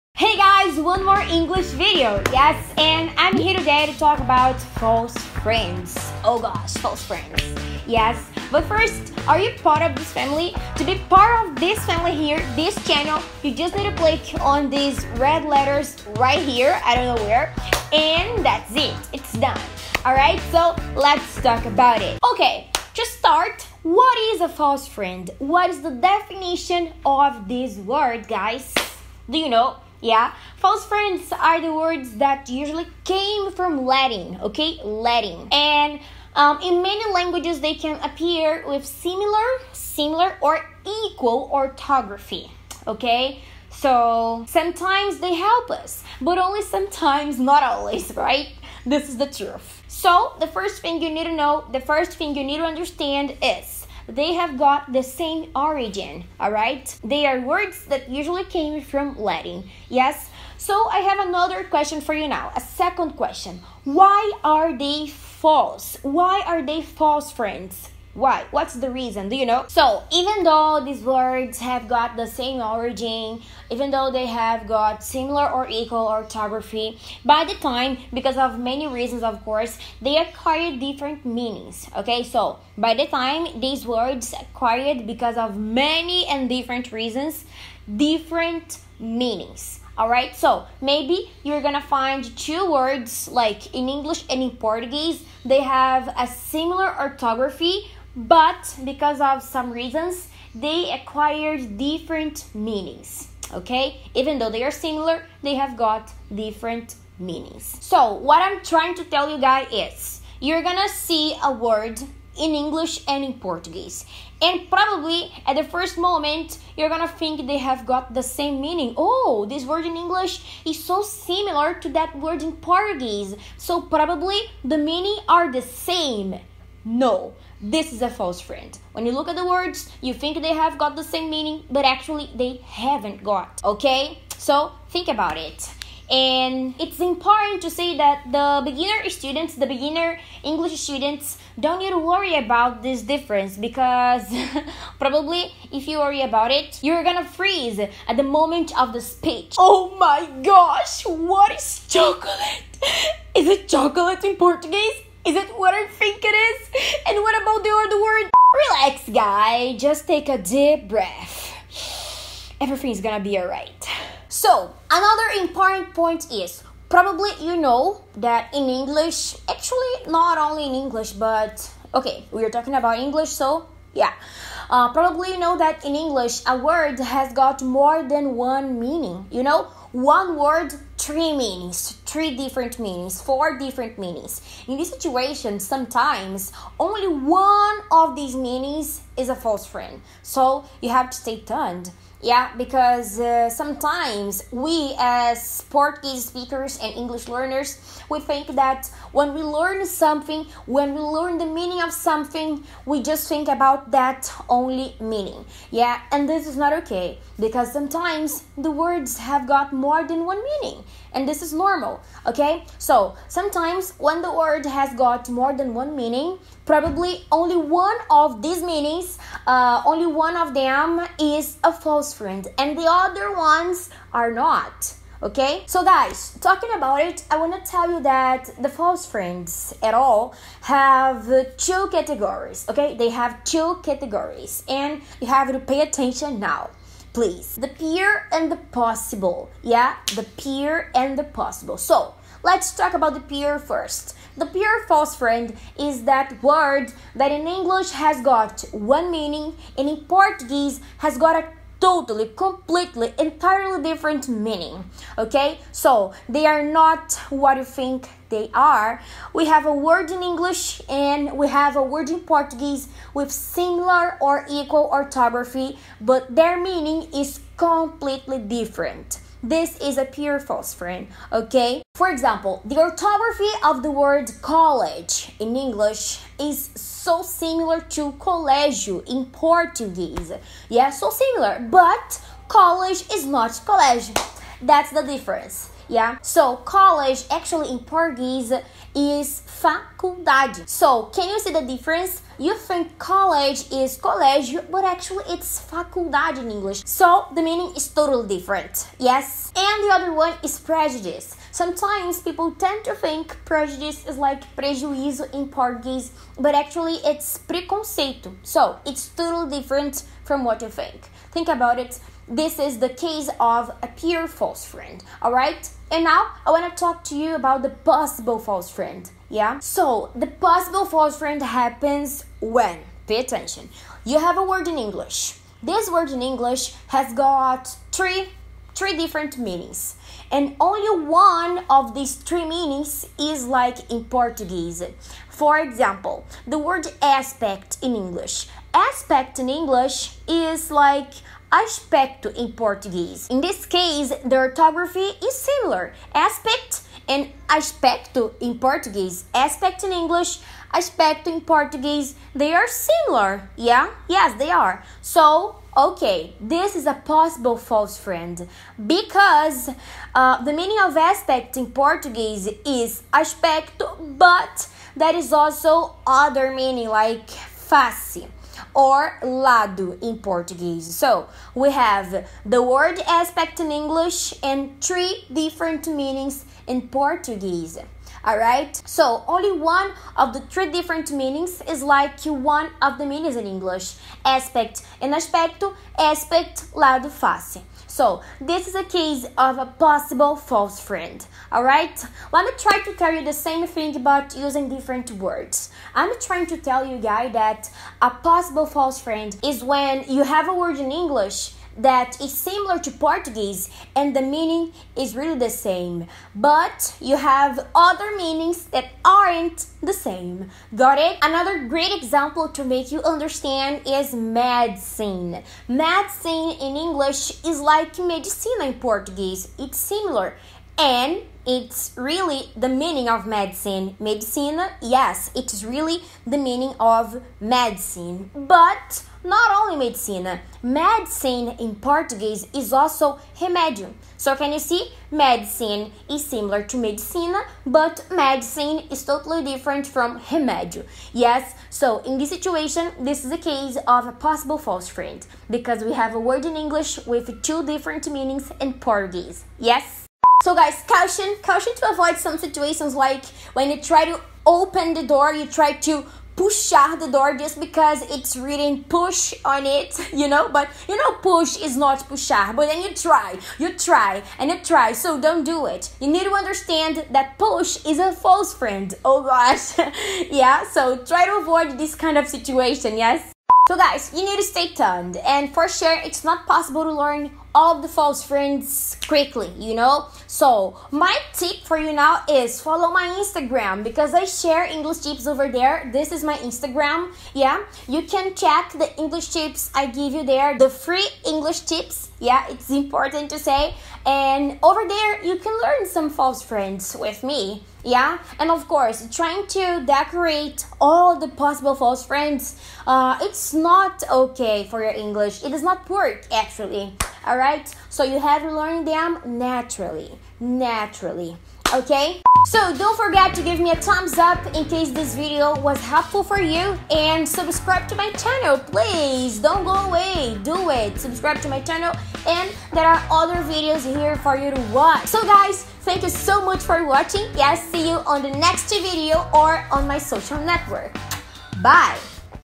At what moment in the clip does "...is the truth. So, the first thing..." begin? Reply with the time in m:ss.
0:49.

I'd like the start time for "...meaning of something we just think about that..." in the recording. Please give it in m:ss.
3:21.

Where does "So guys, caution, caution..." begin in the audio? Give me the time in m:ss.
7:30.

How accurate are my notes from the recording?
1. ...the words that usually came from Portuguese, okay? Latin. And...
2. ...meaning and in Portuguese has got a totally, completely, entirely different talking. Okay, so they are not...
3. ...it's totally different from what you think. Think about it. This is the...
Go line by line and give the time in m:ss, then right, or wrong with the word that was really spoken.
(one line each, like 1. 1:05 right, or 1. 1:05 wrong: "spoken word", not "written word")
1. 0:31 wrong: "Latin", not "Portuguese"
2. 4:09 wrong: "meaning", not "talking"
3. 5:08 right.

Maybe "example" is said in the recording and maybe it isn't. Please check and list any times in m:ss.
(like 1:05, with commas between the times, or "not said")
4:32, 5:35, 6:51.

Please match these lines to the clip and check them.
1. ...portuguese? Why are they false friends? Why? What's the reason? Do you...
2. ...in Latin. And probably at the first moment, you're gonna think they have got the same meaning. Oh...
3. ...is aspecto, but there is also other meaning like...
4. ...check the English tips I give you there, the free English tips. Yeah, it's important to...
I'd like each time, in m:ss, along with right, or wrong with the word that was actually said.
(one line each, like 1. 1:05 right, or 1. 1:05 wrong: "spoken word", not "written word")
1. 1:05 wrong: "false", not "portuguese"
2. 1:53 wrong: "Portuguese", not "Latin"
3. 6:02 right
4. 8:08 right.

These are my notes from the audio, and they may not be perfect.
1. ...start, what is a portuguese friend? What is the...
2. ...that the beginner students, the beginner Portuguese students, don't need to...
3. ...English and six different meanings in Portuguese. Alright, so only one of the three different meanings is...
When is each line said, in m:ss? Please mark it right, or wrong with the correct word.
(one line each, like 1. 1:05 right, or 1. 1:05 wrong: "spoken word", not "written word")
1. 0:23 wrong: "false", not "portuguese"
2. 2:17 wrong: "English", not "Portuguese"
3. 6:13 wrong: "three", not "six".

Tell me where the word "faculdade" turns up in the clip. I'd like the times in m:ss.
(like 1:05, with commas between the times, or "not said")
4:49, 4:55.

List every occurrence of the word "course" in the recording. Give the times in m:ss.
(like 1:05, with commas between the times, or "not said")
1:19, 8:18.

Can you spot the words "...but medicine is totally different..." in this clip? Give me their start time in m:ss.
7:17.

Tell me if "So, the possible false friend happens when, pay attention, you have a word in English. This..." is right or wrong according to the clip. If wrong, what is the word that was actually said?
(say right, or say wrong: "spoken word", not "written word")
right.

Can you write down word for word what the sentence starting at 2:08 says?
When you look at the words, you think they have got the same meaning, but actually they haven't got, okay?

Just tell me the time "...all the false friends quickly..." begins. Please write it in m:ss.
7:57.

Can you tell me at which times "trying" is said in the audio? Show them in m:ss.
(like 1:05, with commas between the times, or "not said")
1:48, 6:36, 8:19.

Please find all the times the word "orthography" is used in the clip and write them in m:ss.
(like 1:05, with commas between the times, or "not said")
0:41, 1:16, 1:36, 4:24, 4:32, 5:44.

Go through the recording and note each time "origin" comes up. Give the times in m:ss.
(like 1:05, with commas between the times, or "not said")
0:55, 1:12.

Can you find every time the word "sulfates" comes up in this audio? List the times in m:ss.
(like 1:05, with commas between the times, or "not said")
not said.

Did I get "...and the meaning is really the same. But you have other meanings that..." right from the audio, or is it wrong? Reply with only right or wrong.
right.